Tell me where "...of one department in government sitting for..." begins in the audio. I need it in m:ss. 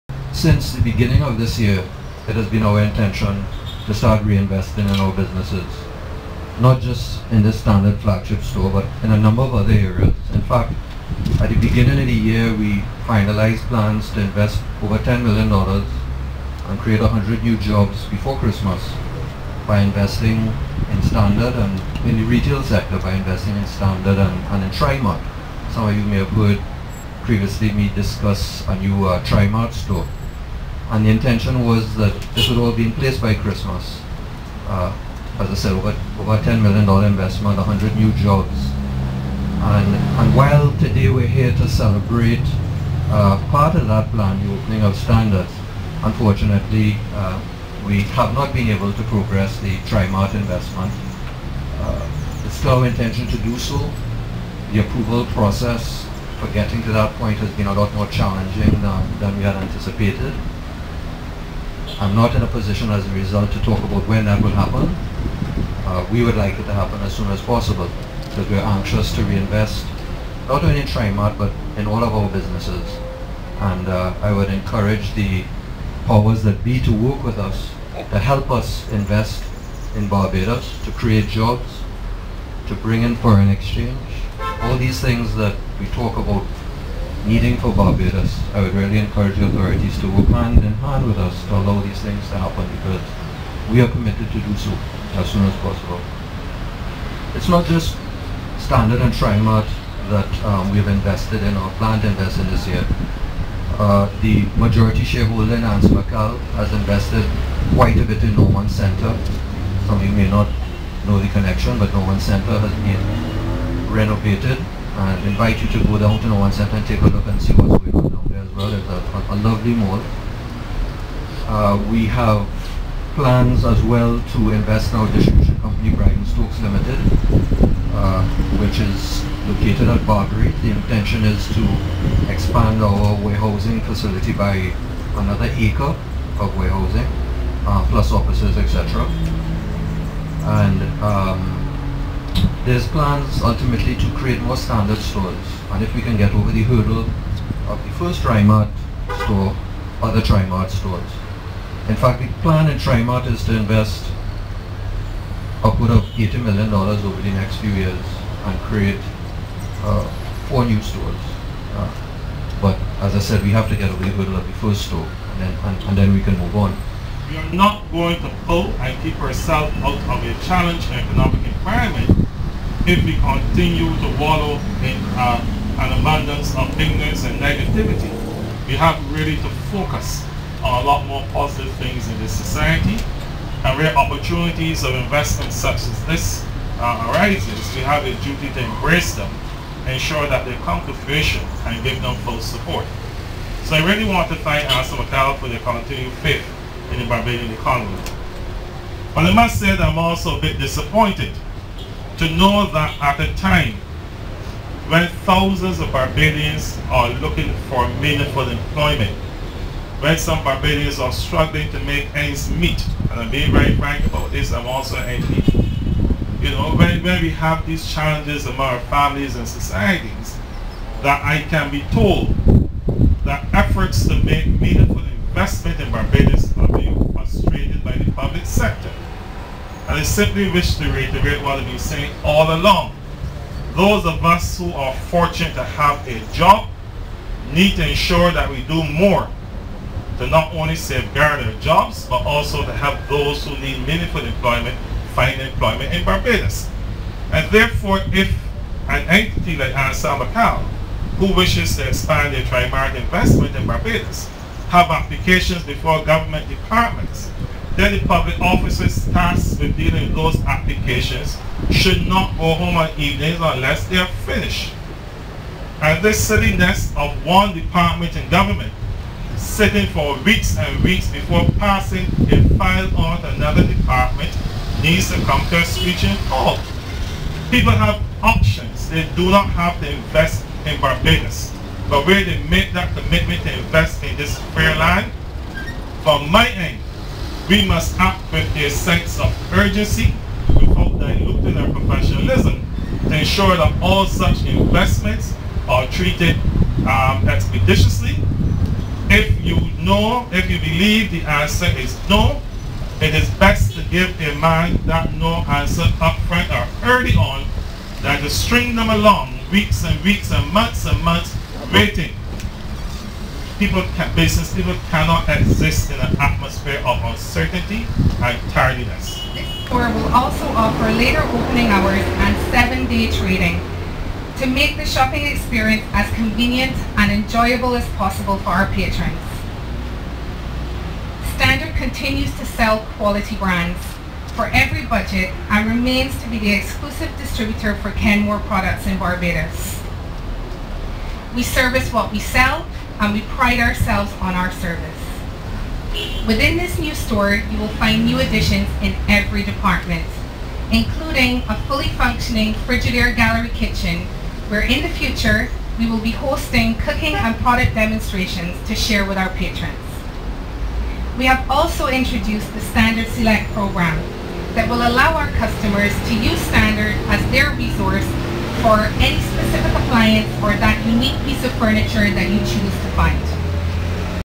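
4:26.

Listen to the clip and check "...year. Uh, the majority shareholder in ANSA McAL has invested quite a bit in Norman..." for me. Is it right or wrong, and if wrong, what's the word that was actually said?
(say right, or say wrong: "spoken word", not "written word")
right.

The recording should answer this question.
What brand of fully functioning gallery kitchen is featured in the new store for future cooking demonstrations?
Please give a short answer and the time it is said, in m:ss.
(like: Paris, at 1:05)
Frigidaire, at 5:52.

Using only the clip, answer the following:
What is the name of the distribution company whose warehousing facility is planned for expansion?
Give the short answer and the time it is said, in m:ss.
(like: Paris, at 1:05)
Brydens Stokes Limited, at 2:05.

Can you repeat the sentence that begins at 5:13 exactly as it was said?
People can, business people cannot exist in an of uncertainty and tardiness.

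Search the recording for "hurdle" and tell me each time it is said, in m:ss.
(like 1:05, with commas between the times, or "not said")
2:26, 2:44.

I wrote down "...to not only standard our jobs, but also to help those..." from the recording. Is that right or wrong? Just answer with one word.
wrong.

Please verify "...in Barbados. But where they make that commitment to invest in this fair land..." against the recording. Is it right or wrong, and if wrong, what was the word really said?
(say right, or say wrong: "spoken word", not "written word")
right.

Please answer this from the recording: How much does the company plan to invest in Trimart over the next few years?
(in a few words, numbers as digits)
$80 million.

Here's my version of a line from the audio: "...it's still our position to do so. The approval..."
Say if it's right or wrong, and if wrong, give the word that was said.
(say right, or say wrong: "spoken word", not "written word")
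wrong: "intention", not "position".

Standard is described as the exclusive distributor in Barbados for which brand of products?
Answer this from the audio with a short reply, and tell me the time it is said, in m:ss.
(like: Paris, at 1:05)
Kenmore, at 5:37.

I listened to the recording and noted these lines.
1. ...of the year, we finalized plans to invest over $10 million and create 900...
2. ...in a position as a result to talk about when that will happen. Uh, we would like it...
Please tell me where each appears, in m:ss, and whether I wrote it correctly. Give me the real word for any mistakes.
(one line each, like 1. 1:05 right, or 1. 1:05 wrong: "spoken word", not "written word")
1. 0:11 wrong: "100", not "900"
2. 1:02 right.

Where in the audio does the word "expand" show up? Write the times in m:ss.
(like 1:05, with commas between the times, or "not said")
2:12, 4:11.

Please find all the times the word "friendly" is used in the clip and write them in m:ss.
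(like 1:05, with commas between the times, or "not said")
not said.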